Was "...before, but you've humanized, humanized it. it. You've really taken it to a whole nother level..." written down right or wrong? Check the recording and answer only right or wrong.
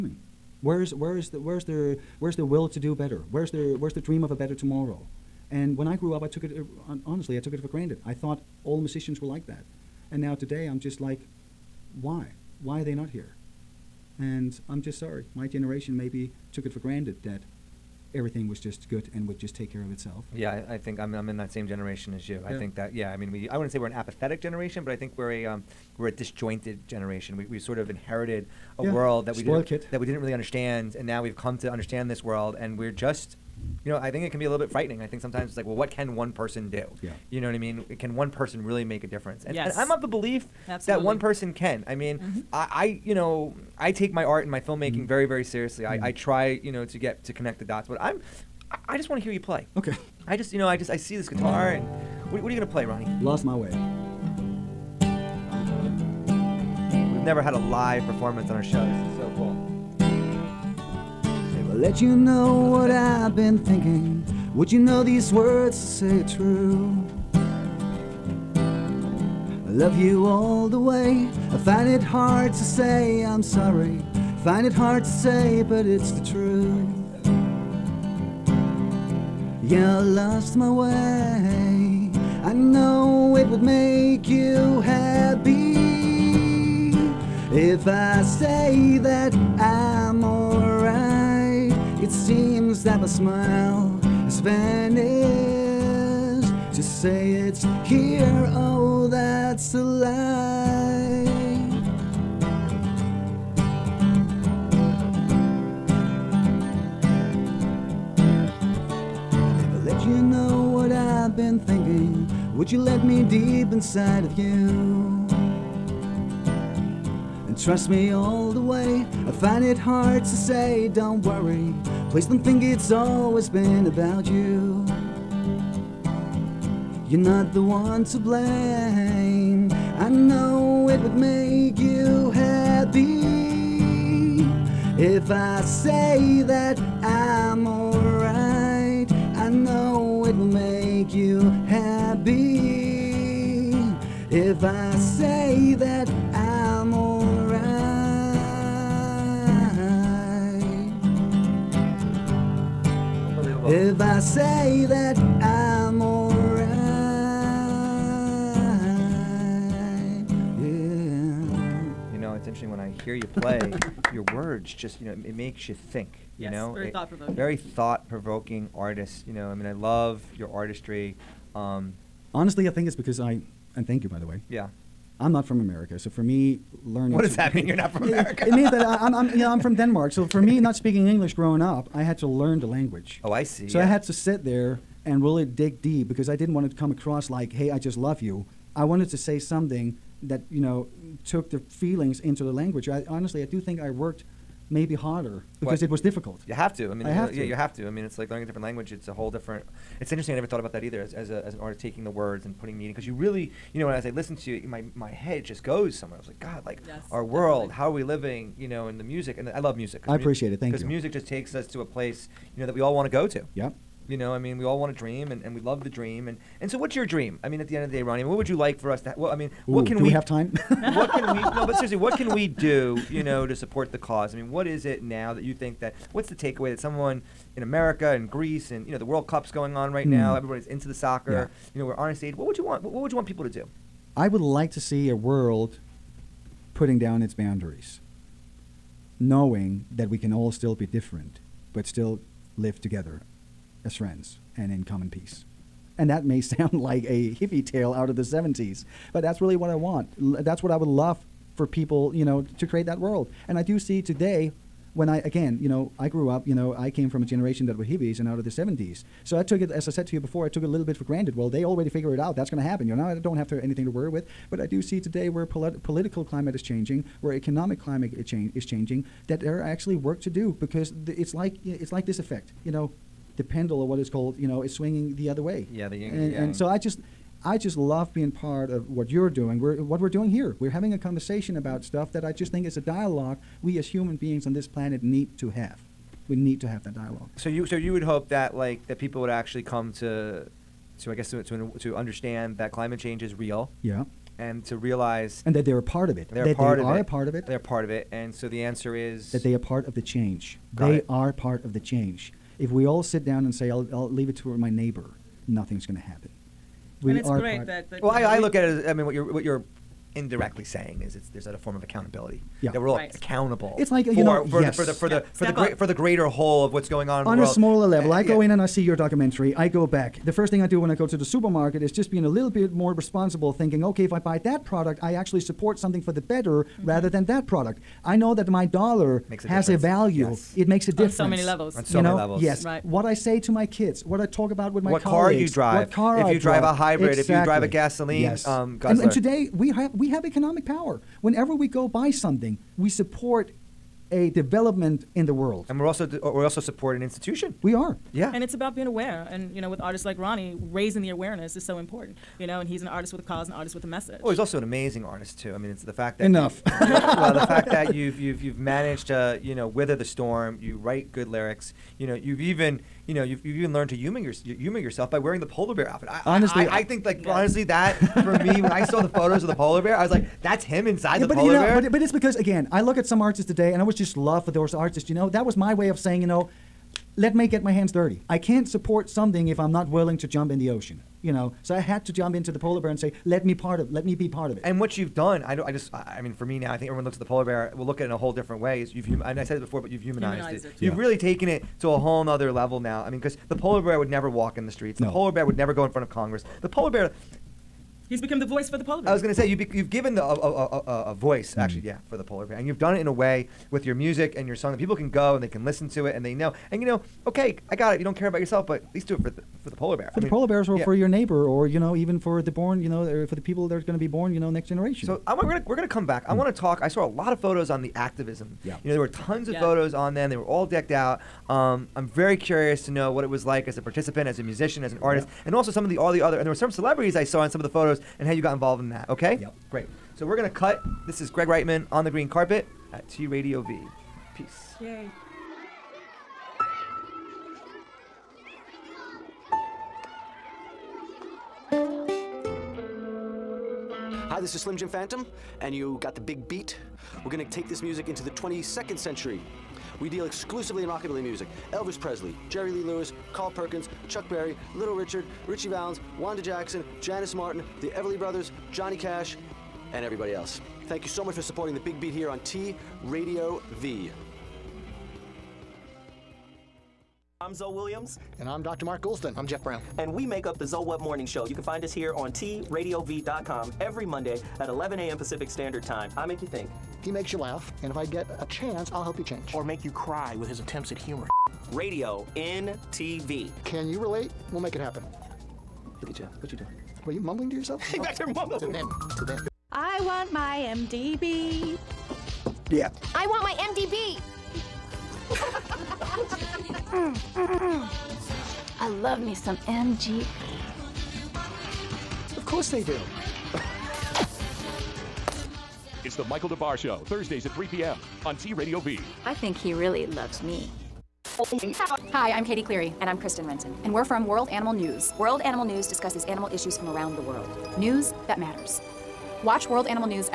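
right.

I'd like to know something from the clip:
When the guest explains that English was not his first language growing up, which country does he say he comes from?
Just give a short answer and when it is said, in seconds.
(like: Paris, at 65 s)
Denmark, at 179 s.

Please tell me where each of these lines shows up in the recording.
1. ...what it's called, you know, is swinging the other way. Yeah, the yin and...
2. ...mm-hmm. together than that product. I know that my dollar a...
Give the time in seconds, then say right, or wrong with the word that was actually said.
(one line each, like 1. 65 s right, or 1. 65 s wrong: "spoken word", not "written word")
1. 273 s right
2. 326 s wrong: "rather", not "together".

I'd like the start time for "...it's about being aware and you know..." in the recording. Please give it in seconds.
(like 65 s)
348 s.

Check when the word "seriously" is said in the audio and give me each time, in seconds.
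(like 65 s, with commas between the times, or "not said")
45 s, 221 s.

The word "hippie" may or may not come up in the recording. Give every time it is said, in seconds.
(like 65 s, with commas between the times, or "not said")
247 s, 257 s.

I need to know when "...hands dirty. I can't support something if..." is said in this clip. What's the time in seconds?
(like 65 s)
377 s.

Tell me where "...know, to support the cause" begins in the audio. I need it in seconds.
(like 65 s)
223 s.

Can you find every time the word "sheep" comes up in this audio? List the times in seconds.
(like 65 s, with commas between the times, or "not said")
not said.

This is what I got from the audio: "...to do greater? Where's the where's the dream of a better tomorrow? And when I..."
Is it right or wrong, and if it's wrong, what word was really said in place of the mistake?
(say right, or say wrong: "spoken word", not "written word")
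wrong: "better", not "greater".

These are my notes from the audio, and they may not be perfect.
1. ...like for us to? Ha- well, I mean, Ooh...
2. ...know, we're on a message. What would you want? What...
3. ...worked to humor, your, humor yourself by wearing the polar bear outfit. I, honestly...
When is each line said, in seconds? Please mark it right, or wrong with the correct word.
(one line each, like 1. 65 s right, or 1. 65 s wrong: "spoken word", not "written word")
1. 218 s right
2. 231 s wrong: "stage", not "message"
3. 363 s wrong: "learned", not "worked".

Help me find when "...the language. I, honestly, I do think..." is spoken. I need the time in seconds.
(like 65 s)
192 s.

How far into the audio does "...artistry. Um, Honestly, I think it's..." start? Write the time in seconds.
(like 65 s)
170 s.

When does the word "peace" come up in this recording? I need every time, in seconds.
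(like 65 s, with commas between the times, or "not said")
245 s, 434 s.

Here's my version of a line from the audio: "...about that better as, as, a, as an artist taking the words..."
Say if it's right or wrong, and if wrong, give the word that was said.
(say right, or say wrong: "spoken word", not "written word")
wrong: "either", not "better".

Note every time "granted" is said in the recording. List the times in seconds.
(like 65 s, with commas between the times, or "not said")
7 s, 16 s, 261 s.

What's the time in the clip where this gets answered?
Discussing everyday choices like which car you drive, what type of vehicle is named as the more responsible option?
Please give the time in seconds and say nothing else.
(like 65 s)
336 s.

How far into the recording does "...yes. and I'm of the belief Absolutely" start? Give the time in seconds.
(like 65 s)
39 s.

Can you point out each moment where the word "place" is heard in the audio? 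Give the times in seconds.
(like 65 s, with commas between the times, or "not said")
211 s.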